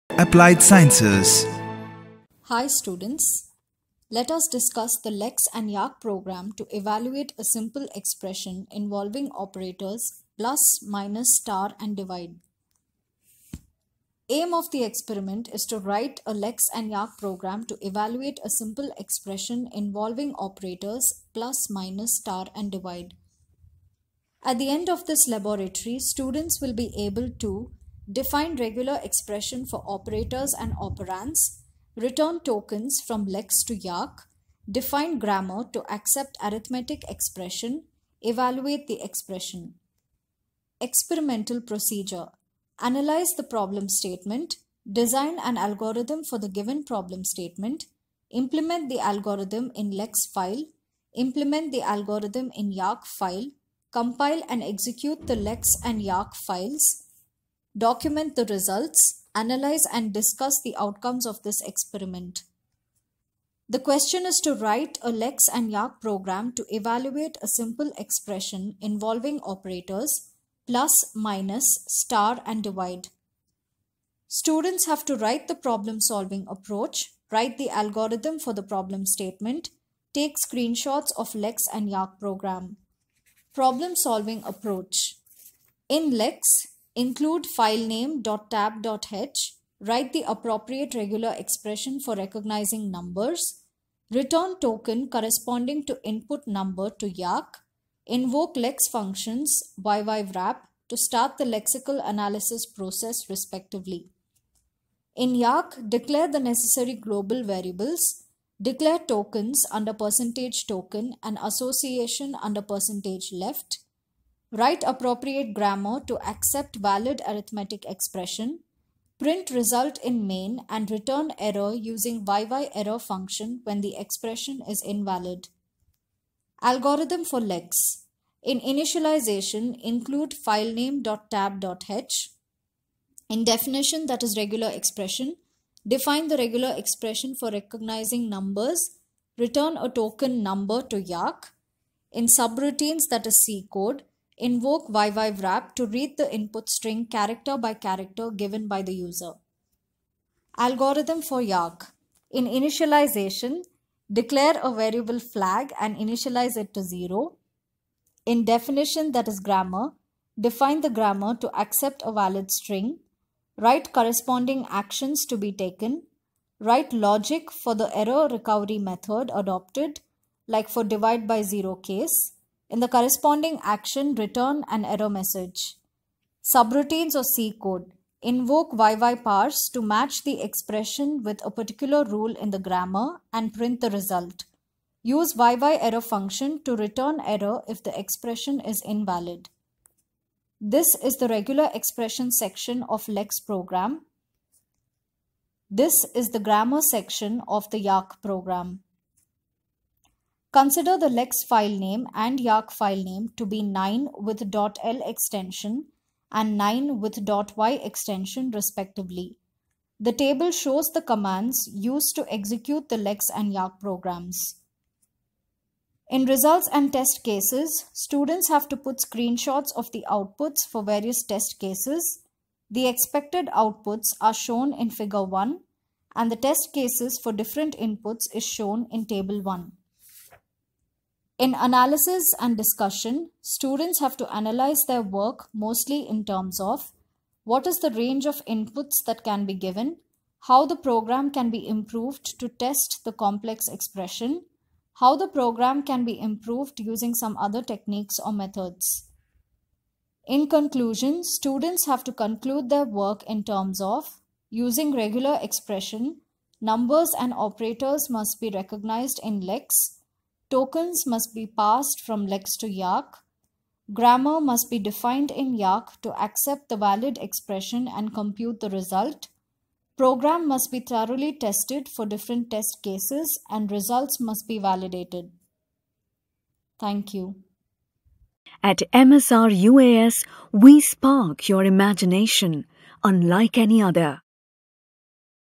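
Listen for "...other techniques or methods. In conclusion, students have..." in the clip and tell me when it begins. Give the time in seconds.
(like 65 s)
247 s.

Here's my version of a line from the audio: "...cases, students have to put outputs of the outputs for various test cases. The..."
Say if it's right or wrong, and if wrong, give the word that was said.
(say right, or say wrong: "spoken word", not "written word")
wrong: "screenshots", not "outputs".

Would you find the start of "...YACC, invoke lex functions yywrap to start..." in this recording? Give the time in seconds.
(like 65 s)
97 s.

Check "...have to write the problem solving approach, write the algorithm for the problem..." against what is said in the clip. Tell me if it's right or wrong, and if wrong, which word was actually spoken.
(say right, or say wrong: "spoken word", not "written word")
right.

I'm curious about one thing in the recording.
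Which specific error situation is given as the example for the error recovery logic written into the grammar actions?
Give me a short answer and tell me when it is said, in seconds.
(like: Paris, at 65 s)
divide by 0, at 170 s.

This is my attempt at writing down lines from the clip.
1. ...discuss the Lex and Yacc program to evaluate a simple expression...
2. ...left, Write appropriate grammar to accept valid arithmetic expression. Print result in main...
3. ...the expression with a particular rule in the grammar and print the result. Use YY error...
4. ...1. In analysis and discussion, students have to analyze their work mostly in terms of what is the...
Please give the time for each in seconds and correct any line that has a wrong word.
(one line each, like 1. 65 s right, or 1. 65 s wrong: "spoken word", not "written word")
1. 4 s right
2. 113 s right
3. 180 s right
4. 229 s right.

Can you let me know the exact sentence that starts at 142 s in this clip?
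In subroutines, that is C code, Invoke YYWrap to read the input string character by character given by the user.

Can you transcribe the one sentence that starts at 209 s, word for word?
The table shows the commands used to execute the lex and yacc programs.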